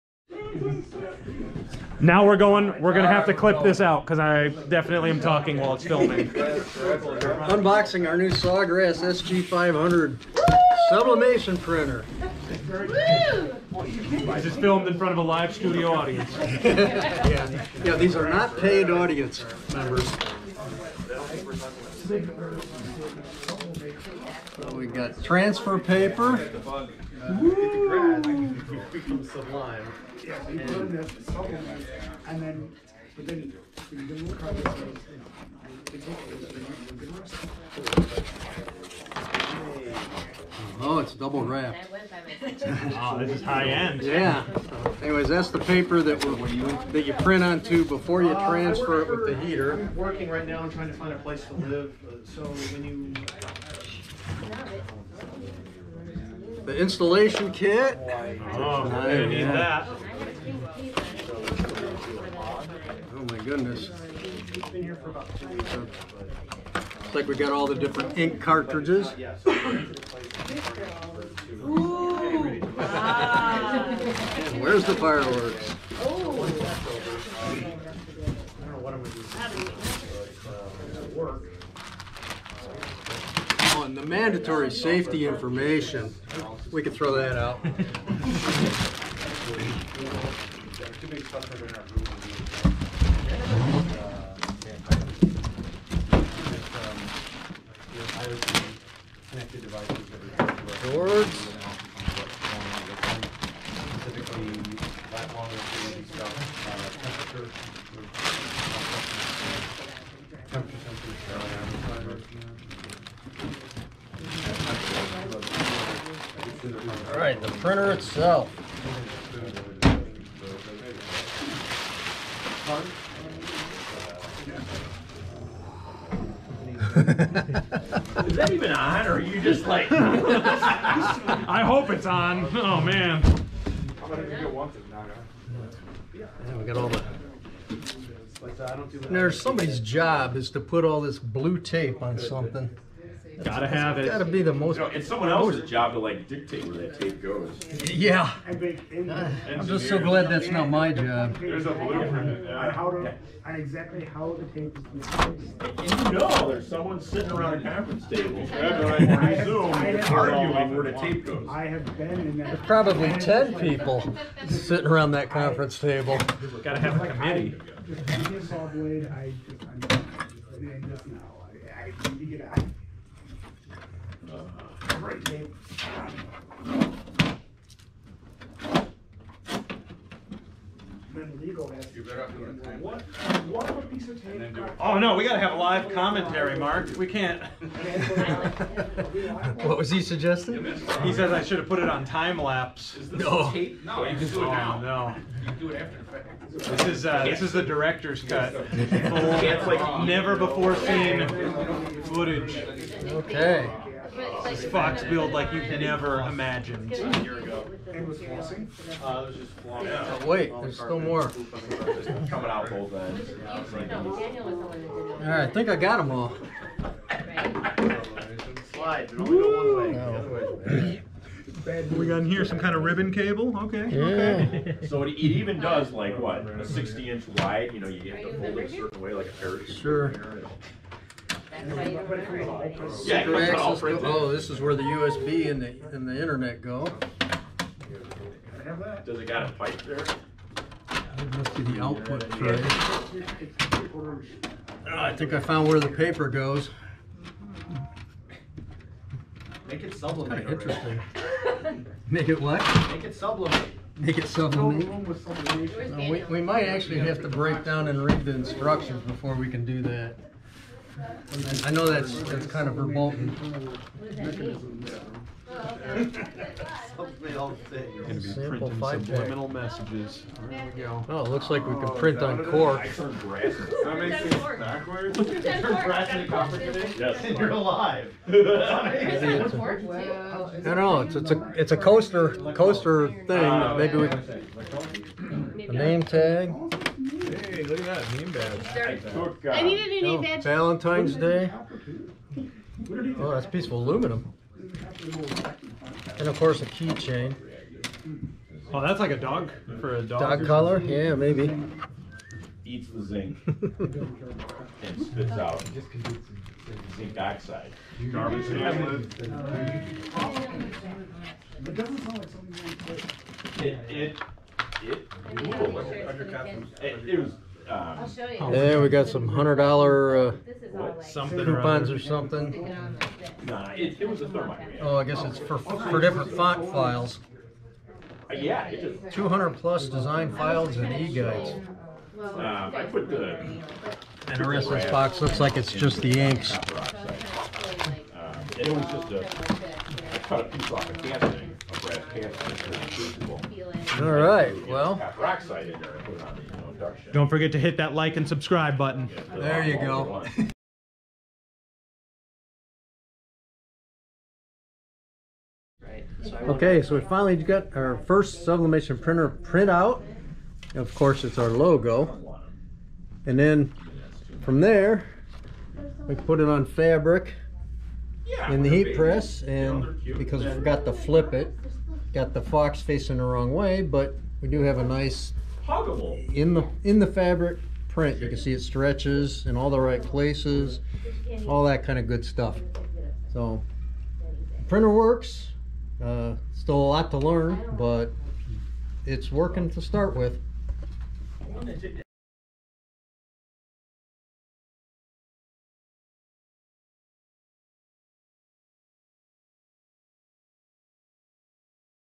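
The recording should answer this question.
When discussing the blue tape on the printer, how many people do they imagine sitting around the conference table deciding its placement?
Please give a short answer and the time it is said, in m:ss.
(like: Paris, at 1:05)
10, at 2:43.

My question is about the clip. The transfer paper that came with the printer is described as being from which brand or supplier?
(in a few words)
Sublime.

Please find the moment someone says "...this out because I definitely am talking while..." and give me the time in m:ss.
0:03.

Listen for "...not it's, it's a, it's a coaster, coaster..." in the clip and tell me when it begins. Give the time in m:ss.
4:40.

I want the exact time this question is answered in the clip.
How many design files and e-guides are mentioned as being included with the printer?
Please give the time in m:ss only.
5:29.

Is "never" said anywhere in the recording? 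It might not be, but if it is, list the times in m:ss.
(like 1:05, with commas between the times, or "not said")
3:20, 3:25.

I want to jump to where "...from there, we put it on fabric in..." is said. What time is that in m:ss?
6:04.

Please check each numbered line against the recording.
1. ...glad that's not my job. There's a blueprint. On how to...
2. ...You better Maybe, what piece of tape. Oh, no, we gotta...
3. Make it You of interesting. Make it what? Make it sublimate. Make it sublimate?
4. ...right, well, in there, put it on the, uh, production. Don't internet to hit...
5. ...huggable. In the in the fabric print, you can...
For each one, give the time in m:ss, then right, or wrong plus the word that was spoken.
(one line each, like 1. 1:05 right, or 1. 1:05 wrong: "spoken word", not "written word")
1. 2:29 right
2. 3:01 wrong: "What", not "Maybe"
3. 4:09 wrong: "Kind", not "You"
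4. 5:44 wrong: "forget", not "internet"
5. 6:15 right.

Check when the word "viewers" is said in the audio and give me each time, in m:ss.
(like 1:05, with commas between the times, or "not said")
not said.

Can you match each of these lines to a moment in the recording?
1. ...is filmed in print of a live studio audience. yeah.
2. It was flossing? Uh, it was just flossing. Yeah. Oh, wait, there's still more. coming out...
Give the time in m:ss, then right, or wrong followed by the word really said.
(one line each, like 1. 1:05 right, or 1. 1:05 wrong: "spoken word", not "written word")
1. 0:14 wrong: "front", not "print"
2. 3:27 right.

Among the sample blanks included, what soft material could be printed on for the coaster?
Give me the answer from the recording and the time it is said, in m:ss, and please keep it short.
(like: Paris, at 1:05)
cork, at 4:32.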